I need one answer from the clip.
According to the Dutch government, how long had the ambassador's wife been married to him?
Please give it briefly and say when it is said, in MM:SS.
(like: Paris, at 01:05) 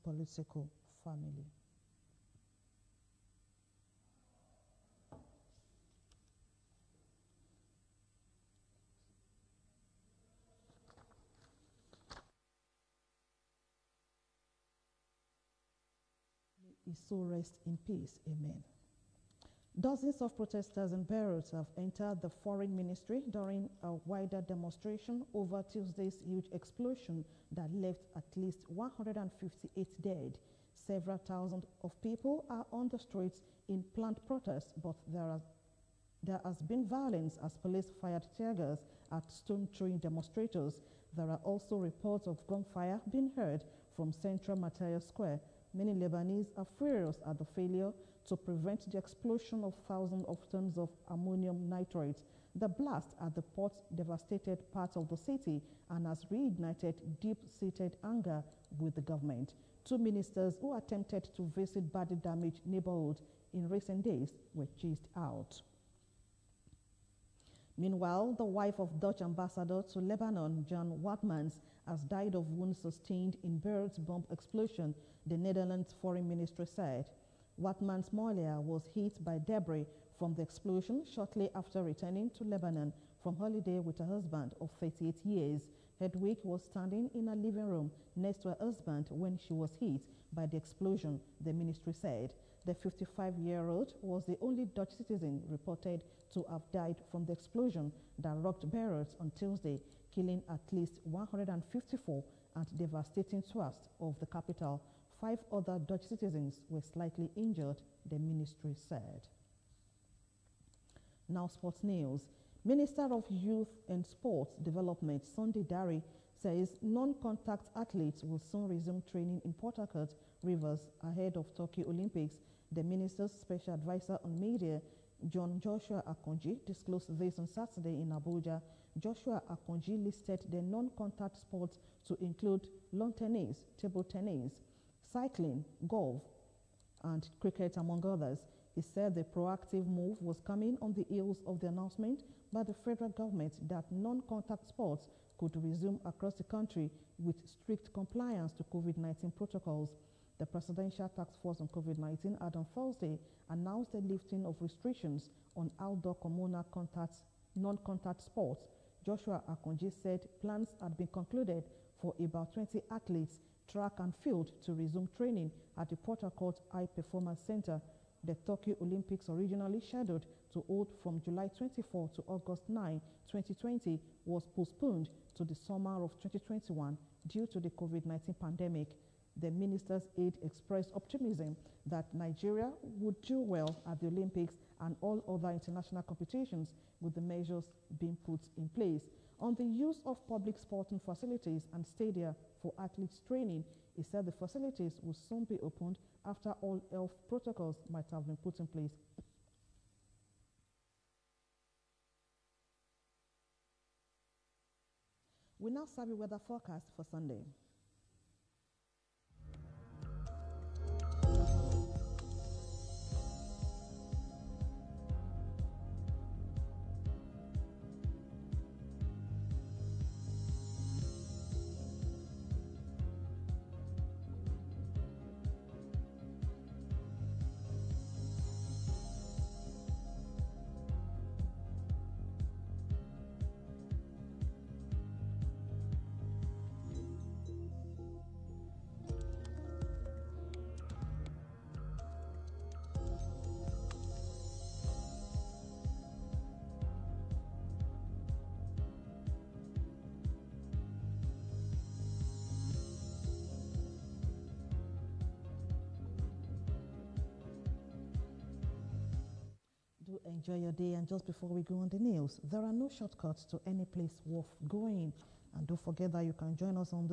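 38 years, at 01:24.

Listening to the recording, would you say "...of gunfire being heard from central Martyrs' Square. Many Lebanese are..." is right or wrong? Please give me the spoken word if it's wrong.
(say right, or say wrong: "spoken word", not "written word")
right.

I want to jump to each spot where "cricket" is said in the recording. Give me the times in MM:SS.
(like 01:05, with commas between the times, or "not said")
02:17.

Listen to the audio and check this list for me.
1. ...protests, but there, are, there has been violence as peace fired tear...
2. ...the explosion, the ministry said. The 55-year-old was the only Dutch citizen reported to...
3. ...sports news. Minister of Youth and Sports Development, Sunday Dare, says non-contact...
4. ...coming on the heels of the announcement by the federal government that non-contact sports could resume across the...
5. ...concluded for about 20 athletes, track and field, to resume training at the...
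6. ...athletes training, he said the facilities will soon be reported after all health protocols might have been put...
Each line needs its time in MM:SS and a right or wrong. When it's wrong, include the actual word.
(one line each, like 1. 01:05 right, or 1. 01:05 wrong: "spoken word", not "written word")
1. 00:34 wrong: "police", not "peace"
2. 01:30 right
3. 01:51 right
4. 02:20 right
5. 02:41 right
6. 03:12 wrong: "opened", not "reported".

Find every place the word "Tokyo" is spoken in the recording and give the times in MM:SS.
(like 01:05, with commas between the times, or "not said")
02:01, 02:48.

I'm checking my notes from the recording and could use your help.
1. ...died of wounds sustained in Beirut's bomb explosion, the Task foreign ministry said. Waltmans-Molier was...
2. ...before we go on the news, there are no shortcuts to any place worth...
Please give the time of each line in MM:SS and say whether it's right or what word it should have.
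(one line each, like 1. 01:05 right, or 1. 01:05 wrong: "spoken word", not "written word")
1. 01:12 wrong: "Netherlands", not "Task"
2. 04:21 right.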